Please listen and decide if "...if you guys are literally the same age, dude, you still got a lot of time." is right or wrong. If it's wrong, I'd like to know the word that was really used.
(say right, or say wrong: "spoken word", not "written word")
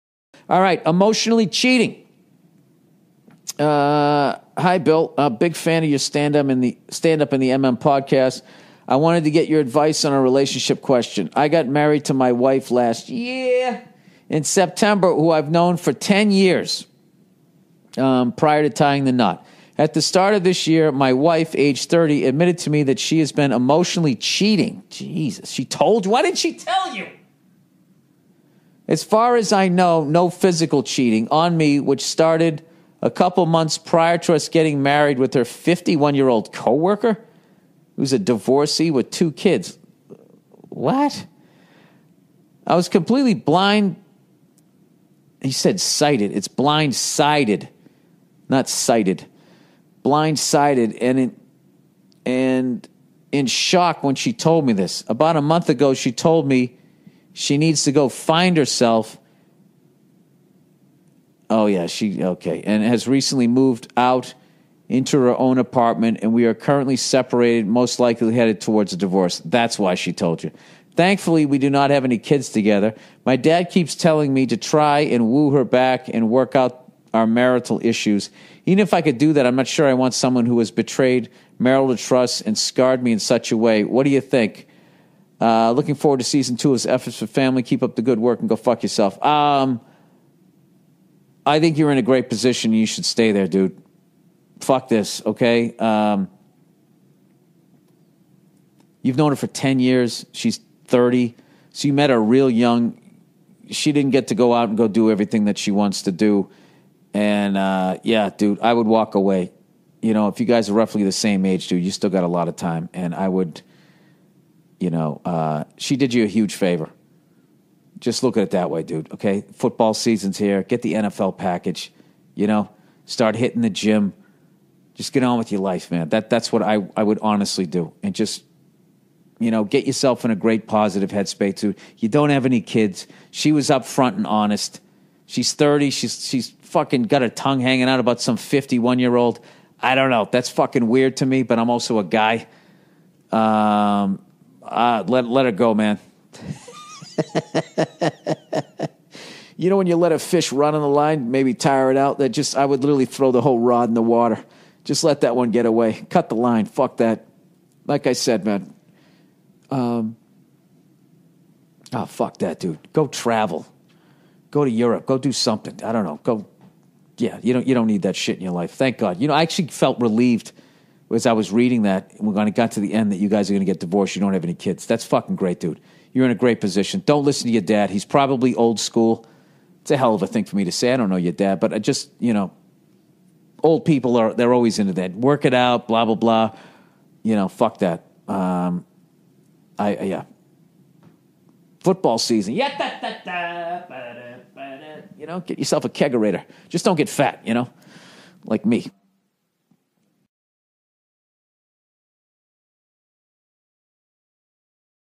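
wrong: "roughly", not "literally".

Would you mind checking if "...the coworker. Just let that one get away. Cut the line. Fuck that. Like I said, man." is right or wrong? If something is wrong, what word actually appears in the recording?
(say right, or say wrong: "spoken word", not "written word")
wrong: "water", not "coworker".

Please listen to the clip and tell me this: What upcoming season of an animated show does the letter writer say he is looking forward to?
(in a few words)
Season two of F Is for Family.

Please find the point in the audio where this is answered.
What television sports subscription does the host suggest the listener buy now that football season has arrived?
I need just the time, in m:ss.
2:00.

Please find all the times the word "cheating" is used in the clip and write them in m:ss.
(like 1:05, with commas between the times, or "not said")
0:01, 0:24, 0:30.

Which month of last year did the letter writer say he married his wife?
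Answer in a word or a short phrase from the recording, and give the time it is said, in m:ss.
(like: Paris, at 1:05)
September, at 0:14.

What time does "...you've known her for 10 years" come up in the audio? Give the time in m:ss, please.
1:39.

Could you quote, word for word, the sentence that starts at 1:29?
Um, I think you're in a great position.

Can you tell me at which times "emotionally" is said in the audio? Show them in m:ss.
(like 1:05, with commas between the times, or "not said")
0:00, 0:23.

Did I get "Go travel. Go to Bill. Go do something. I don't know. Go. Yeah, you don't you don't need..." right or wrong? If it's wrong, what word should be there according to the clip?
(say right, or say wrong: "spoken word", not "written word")
wrong: "Europe", not "Bill".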